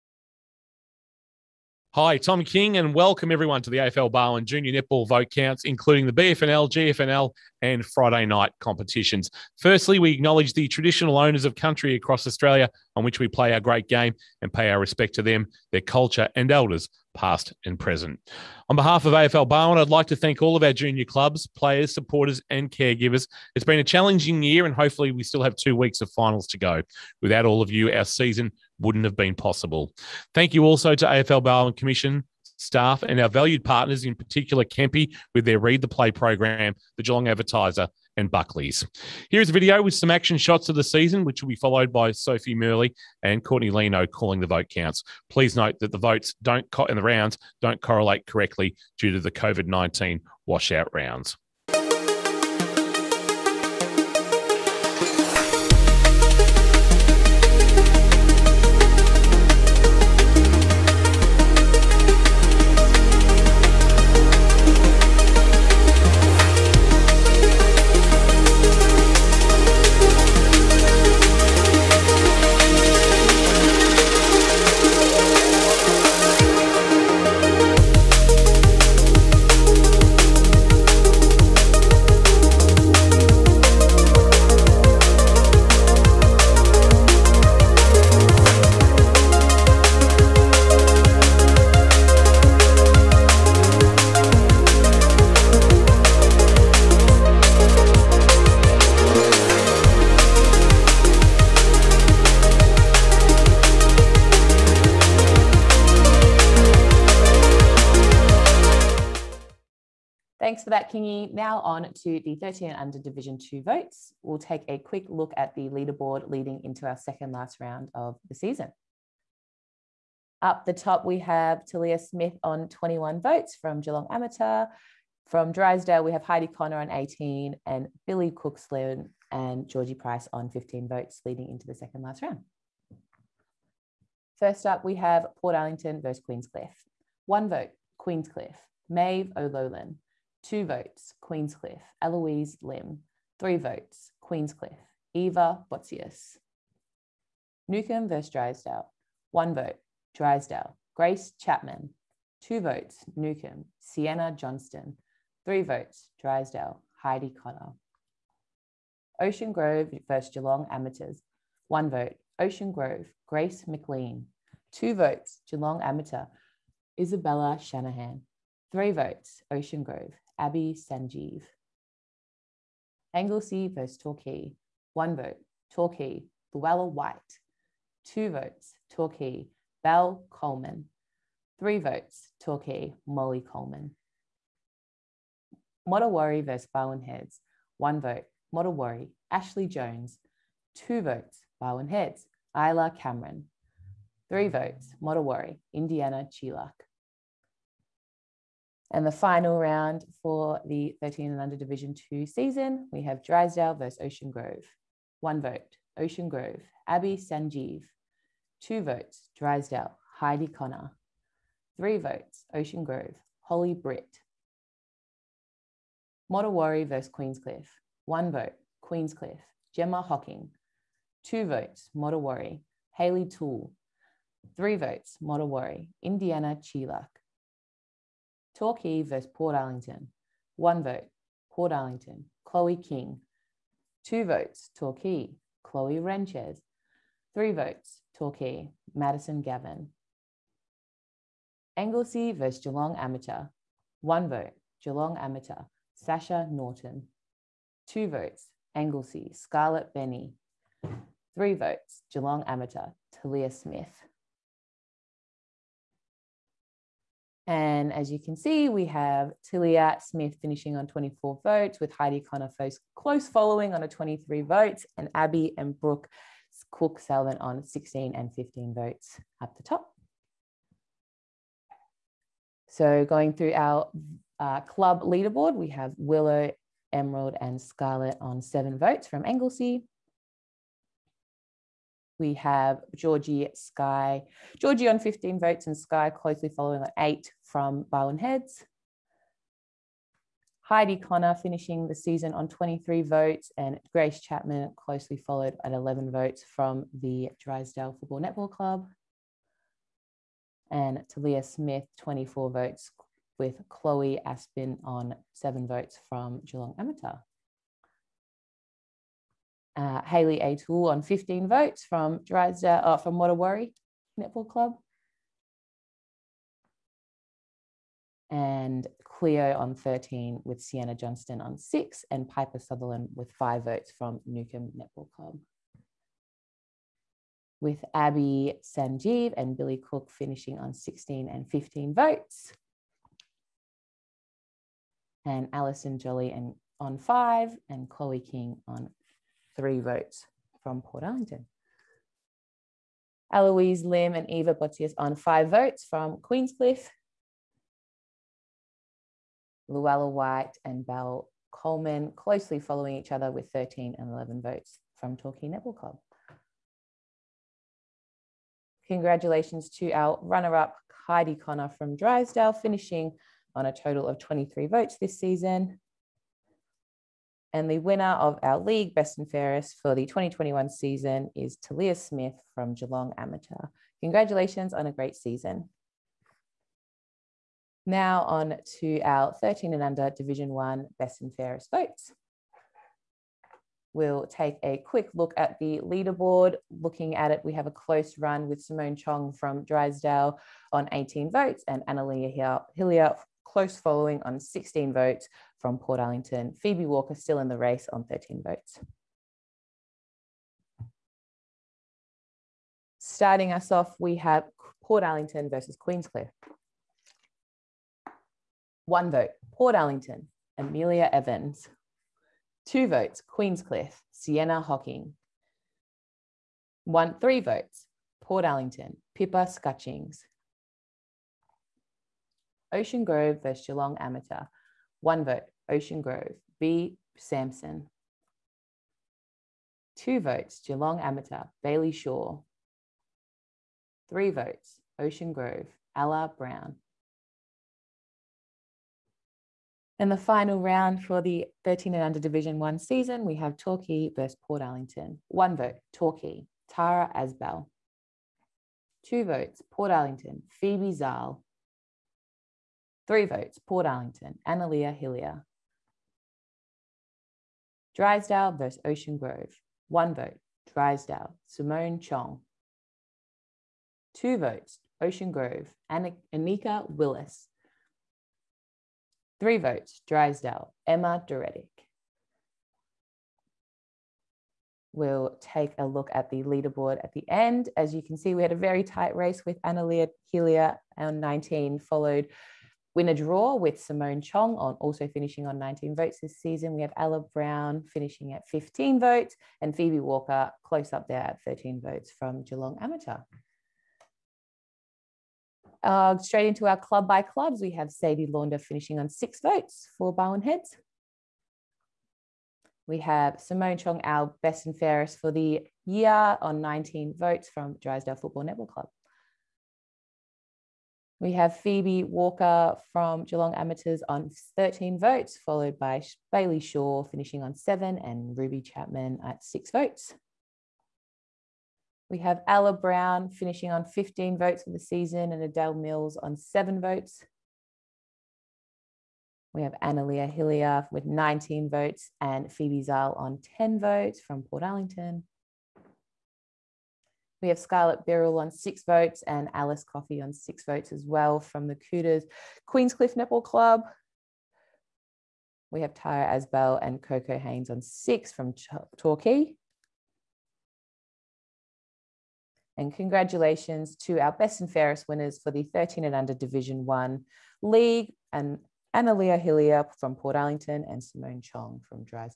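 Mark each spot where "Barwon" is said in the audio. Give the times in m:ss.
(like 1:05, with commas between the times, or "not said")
0:04, 0:19, 0:31, 3:06, 3:11, 4:47, 8:20.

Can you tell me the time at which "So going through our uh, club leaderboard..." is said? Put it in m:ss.
4:32.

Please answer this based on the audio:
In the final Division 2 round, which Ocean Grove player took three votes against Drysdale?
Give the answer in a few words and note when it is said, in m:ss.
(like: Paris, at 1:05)
Holly Britt, at 3:33.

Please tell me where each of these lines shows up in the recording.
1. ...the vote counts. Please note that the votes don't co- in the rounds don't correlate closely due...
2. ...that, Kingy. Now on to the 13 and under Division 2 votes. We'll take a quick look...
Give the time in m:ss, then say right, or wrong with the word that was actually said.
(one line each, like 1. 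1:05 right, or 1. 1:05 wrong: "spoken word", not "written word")
1. 0:44 wrong: "correctly", not "closely"
2. 1:50 right.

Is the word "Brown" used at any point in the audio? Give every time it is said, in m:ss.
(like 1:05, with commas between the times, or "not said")
7:16, 8:07, 8:42.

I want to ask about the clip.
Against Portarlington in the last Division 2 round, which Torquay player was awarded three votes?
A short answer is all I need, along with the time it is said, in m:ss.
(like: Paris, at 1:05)
Madison Gavin, at 3:58.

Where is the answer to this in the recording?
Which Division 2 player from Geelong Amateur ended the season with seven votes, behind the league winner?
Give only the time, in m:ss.
5:03.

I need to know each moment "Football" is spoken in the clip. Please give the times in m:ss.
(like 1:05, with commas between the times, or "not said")
4:57, 8:28.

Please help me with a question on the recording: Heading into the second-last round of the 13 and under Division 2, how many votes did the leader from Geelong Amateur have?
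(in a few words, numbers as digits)
21.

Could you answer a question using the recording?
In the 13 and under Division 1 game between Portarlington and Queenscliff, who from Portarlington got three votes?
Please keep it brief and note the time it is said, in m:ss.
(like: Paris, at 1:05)
Pippa Scutchings, at 6:59.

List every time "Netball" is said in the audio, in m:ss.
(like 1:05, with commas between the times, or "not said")
0:04, 4:58, 5:14, 5:24, 5:55, 8:28, 9:03.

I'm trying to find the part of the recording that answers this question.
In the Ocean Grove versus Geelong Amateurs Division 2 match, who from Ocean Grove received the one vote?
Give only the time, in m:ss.
2:43.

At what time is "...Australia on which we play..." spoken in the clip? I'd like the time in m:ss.
0:12.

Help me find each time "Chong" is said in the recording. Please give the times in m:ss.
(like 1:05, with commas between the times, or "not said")
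6:28, 7:41, 8:04, 8:23, 9:21.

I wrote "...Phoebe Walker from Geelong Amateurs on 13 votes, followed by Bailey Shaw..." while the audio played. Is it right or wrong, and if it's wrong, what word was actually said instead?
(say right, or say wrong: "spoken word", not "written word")
right.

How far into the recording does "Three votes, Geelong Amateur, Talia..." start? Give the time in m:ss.
4:11.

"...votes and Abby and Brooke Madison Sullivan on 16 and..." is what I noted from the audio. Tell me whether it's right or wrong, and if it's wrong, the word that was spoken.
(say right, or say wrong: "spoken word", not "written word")
wrong: "Cook", not "Madison".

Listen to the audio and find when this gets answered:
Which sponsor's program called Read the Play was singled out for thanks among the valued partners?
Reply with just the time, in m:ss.
0:34.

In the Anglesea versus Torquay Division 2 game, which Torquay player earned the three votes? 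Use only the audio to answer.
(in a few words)
Molly Coleman.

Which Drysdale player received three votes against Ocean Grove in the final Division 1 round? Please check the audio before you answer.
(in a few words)
Emma Doretic.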